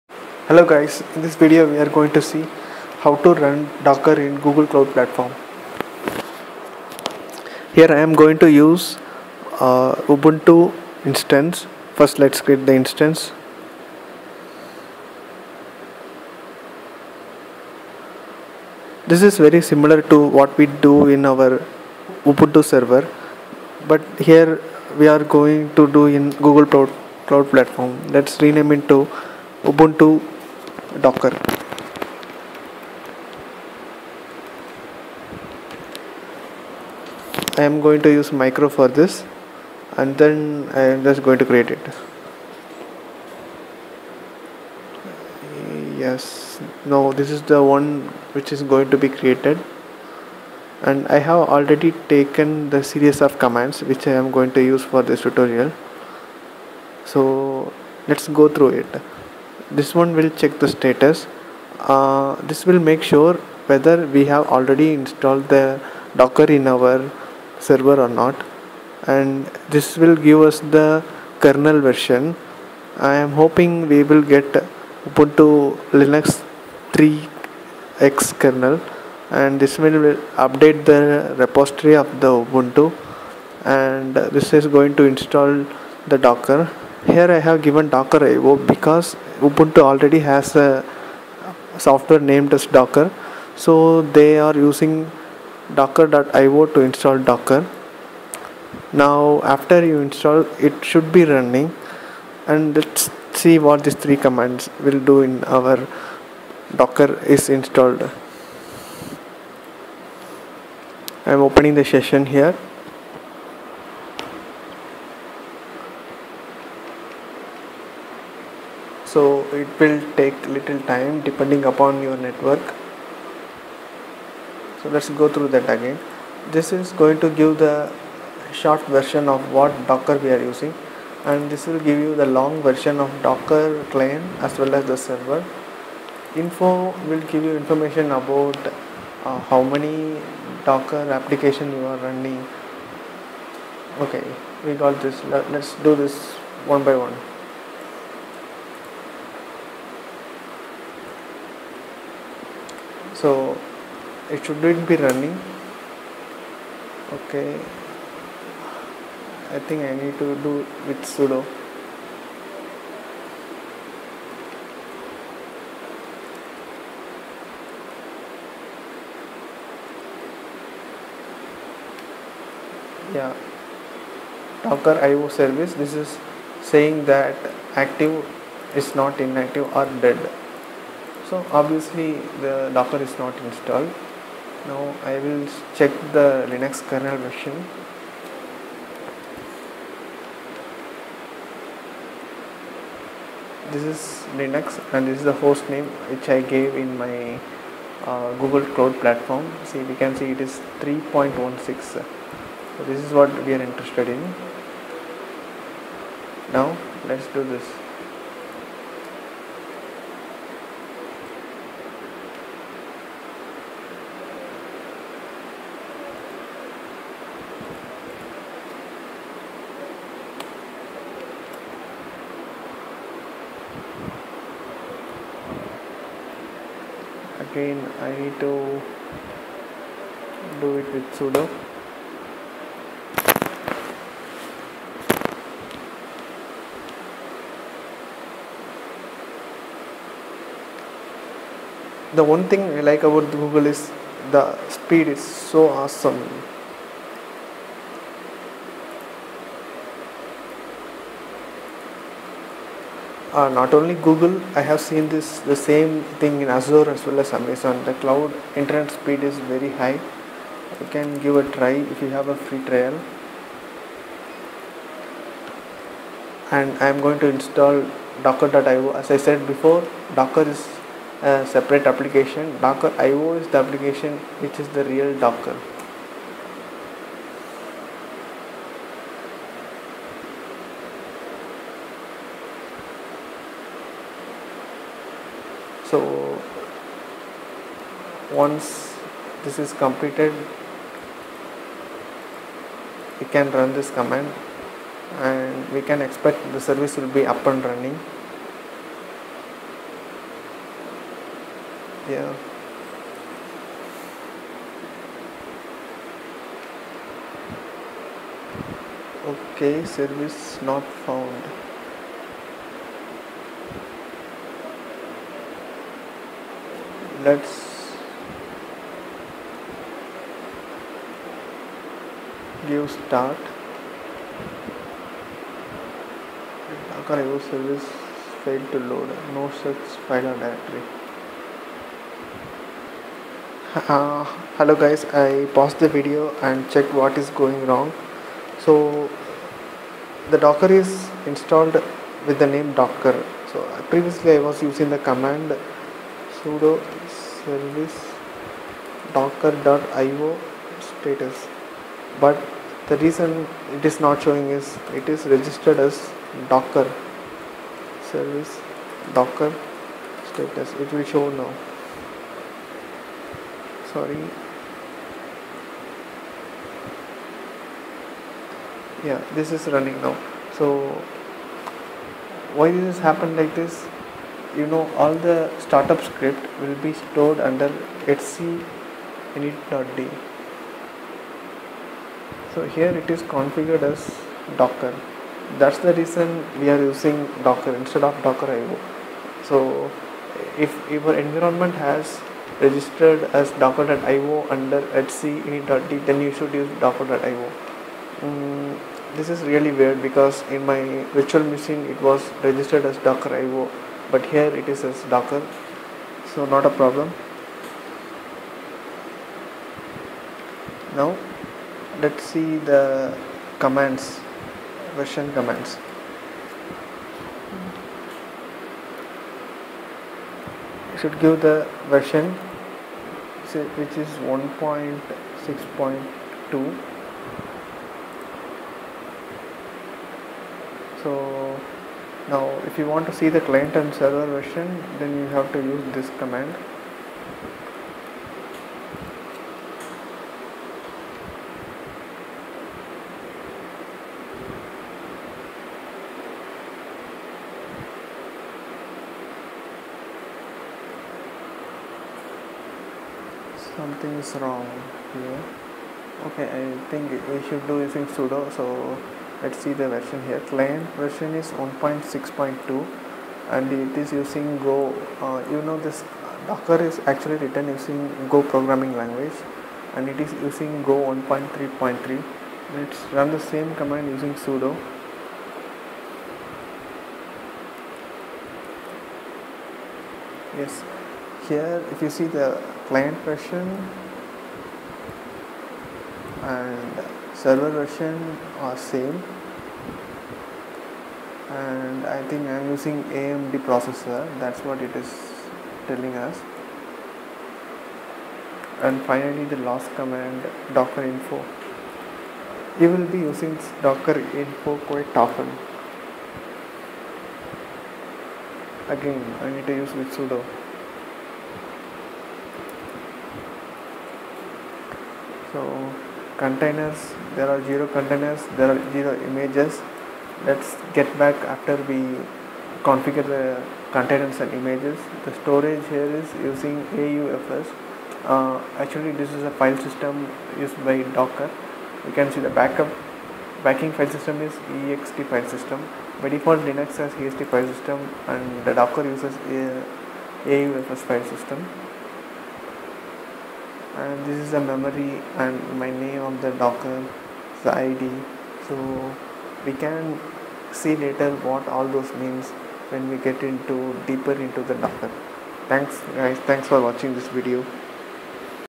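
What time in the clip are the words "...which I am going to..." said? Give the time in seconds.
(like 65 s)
53 s.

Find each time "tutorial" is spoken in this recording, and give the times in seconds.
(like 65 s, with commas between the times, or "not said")
55 s.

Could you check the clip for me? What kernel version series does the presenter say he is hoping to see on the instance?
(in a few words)
3x.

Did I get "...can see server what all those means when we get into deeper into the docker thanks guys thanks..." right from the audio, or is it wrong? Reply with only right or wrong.
wrong.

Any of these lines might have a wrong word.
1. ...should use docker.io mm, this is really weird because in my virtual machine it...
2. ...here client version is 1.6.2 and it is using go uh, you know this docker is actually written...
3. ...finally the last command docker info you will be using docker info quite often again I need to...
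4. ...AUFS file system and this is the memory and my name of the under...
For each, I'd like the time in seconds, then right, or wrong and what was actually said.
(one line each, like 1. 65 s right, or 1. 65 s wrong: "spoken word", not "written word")
1. 396 s right
2. 460 s right
3. 499 s right
4. 540 s wrong: "docker", not "under".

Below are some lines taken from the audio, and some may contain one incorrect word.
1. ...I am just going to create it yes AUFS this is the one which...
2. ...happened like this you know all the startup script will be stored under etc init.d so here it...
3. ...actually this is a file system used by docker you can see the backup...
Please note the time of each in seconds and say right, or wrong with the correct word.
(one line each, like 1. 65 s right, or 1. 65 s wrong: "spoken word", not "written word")
1. 40 s wrong: "Now", not "AUFS"
2. 373 s right
3. 528 s right.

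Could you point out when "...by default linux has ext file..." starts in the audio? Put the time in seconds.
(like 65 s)
536 s.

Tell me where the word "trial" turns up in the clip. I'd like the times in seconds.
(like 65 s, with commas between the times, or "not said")
262 s.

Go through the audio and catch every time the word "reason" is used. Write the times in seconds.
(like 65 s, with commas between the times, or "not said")
353 s, 385 s.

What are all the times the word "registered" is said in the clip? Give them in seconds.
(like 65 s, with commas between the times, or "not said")
355 s, 392 s, 402 s.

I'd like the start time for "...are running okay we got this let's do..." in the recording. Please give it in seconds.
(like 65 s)
141 s.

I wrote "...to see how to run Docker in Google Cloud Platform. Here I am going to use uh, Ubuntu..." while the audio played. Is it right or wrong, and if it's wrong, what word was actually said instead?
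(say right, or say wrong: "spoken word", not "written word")
right.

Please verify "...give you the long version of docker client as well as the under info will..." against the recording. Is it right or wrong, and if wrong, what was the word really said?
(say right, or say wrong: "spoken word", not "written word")
wrong: "server", not "under".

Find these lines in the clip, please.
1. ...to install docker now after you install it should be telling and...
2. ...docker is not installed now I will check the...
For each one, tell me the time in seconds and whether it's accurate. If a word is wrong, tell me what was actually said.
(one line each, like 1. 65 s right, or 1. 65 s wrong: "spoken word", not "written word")
1. 96 s wrong: "running", not "telling"
2. 182 s right.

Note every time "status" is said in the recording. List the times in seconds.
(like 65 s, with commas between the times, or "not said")
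60 s, 350 s, 360 s.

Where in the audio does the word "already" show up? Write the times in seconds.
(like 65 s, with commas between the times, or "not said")
51 s, 64 s, 89 s.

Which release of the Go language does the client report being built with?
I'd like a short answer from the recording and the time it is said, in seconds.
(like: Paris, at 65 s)
1.3.3, at 471 s.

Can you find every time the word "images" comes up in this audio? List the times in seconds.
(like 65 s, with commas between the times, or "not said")
519 s, 524 s.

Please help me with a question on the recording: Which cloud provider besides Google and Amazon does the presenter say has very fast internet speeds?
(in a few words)
Azure.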